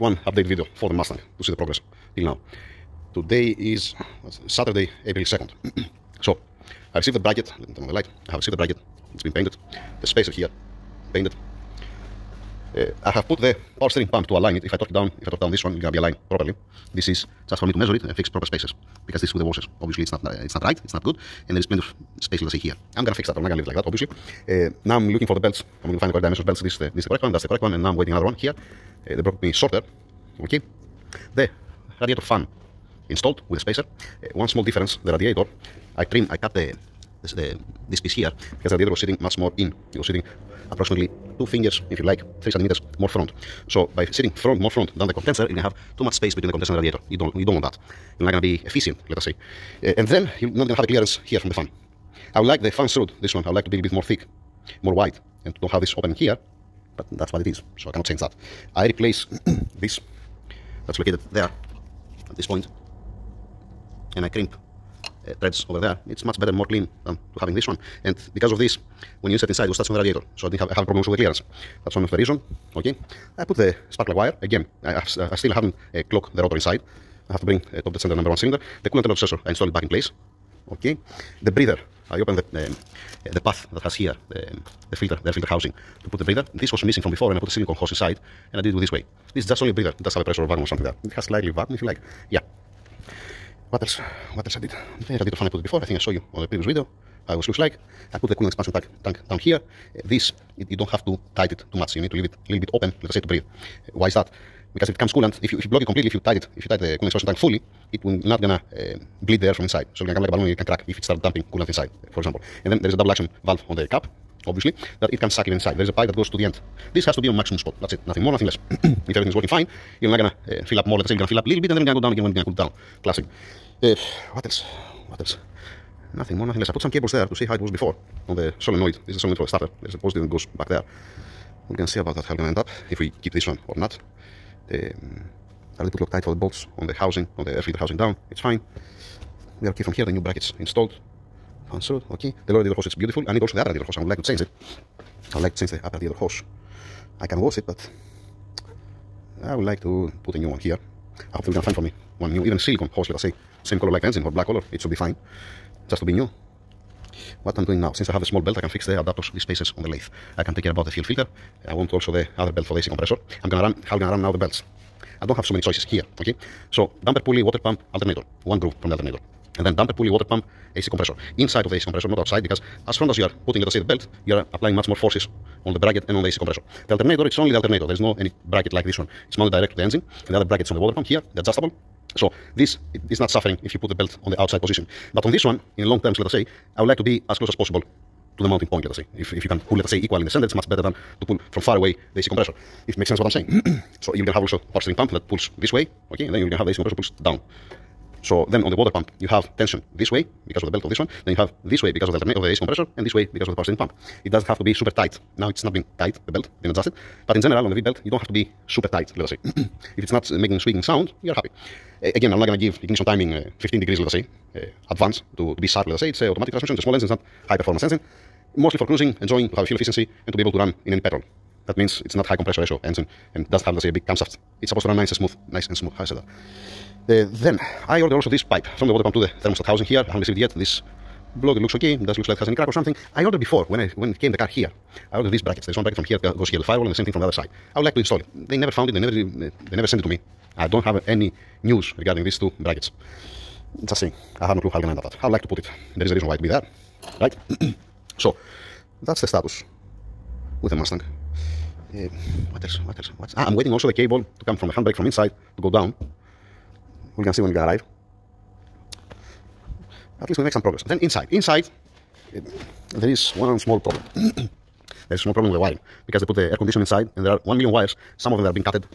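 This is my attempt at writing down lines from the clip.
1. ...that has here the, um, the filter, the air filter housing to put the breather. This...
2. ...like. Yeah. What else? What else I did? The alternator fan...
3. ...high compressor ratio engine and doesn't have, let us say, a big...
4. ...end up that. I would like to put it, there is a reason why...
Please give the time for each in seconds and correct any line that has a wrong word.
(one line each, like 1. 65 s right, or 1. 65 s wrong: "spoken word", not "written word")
1. 83 s right
2. 91 s wrong: "radiator", not "alternator"
3. 222 s right
4. 244 s right.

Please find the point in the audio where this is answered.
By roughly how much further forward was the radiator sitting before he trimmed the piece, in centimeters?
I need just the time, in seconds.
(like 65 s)
42 s.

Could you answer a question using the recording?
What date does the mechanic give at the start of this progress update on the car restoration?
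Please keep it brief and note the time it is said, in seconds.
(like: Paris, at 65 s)
Saturday, April 2nd, at 4 s.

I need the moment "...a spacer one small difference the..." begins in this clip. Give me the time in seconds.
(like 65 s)
33 s.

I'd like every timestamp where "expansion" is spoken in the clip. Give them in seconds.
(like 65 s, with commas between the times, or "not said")
98 s, 107 s.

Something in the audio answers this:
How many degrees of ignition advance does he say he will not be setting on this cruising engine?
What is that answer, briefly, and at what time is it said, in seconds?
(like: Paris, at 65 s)
15 degrees, at 213 s.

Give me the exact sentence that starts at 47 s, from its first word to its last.
You don't, you don't want that.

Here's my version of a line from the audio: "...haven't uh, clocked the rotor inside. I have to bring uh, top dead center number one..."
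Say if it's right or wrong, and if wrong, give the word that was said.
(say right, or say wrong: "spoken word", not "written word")
right.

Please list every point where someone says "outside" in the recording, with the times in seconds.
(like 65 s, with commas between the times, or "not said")
172 s, 184 s.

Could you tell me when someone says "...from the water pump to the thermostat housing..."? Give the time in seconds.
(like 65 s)
228 s.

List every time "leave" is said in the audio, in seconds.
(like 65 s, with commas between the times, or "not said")
23 s, 102 s.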